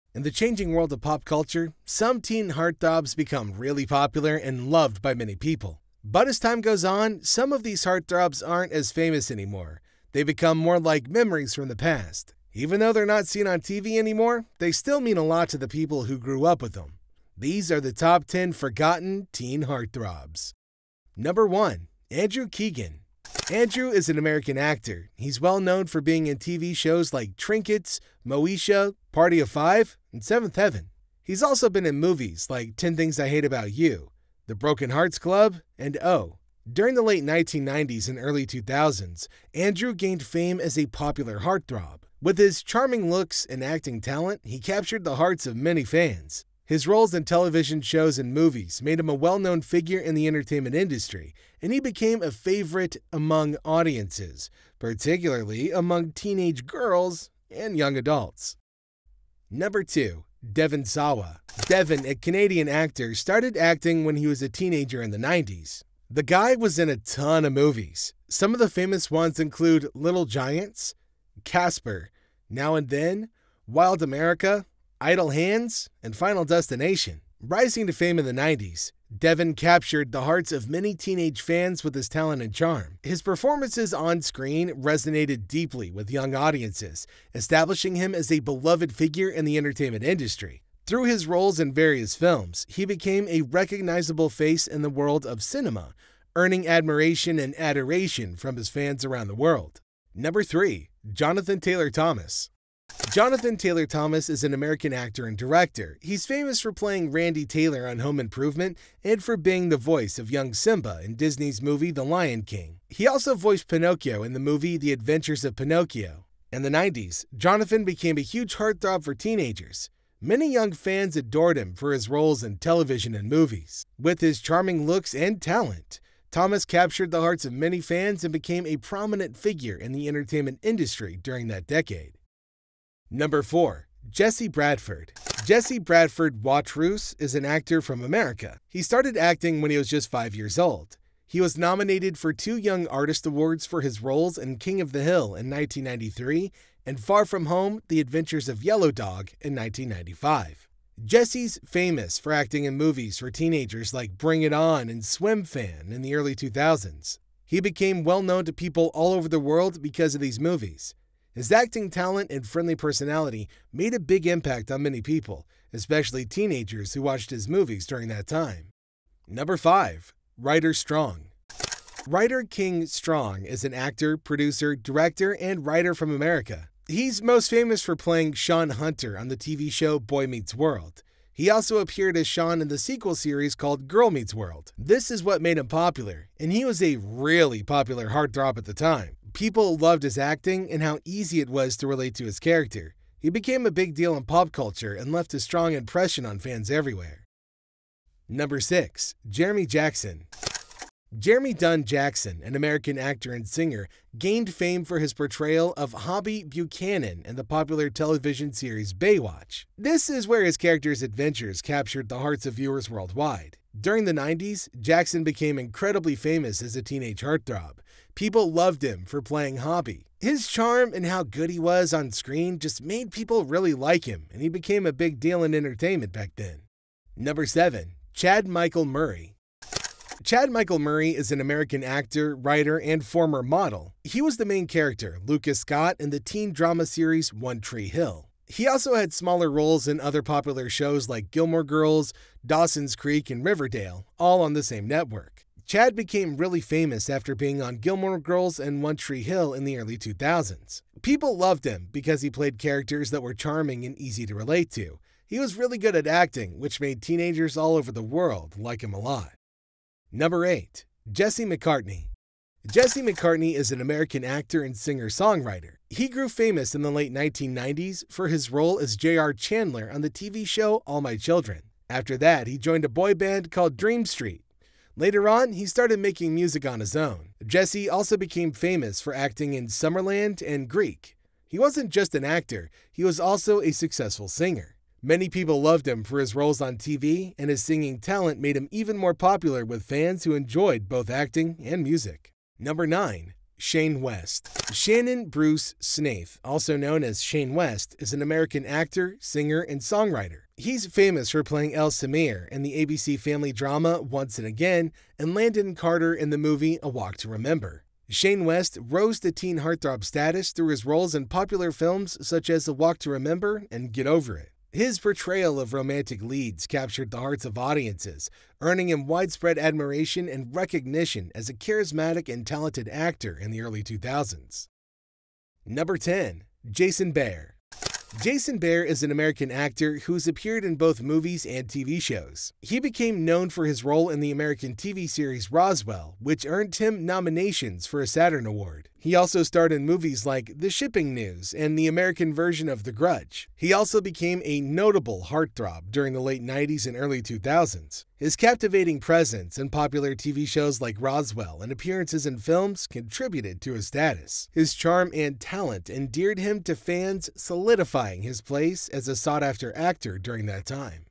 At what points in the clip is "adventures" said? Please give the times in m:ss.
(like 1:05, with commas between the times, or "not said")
1:54, 2:27, 3:31.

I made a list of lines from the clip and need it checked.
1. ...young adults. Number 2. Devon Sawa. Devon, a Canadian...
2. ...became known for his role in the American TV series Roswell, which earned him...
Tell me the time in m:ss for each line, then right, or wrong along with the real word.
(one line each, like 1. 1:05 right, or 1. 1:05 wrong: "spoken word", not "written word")
1. 0:57 right
2. 5:32 right.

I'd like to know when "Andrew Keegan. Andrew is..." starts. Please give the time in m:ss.
0:22.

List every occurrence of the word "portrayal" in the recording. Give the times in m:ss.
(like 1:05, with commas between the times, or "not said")
3:25, 5:14.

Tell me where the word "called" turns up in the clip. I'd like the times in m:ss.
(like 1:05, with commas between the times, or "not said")
3:03, 4:33.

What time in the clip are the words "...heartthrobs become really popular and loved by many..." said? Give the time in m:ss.
0:02.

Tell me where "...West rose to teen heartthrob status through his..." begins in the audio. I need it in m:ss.
5:08.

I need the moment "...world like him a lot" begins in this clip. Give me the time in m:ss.
4:18.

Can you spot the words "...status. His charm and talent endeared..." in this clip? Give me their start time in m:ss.
5:53.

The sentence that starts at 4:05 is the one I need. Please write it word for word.
Chad became really famous after being on Gilmore Girls and One Tree Hill in the early 2000s.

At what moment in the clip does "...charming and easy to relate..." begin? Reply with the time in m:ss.
4:13.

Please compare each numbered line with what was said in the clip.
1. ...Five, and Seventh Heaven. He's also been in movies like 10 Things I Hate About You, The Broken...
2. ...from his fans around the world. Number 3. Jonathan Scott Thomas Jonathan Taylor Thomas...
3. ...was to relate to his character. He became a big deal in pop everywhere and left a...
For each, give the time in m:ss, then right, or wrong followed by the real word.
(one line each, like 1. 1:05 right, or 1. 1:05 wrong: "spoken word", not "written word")
1. 0:29 right
2. 1:38 wrong: "Taylor", not "Scott"
3. 3:11 wrong: "culture", not "everywhere".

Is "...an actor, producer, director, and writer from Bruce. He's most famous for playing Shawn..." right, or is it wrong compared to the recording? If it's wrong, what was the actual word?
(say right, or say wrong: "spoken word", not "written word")
wrong: "America", not "Bruce".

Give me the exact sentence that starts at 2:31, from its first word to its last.
Jesse's famous for acting in movies for teenagers like Bring It On and Swimfan in the early 2000s.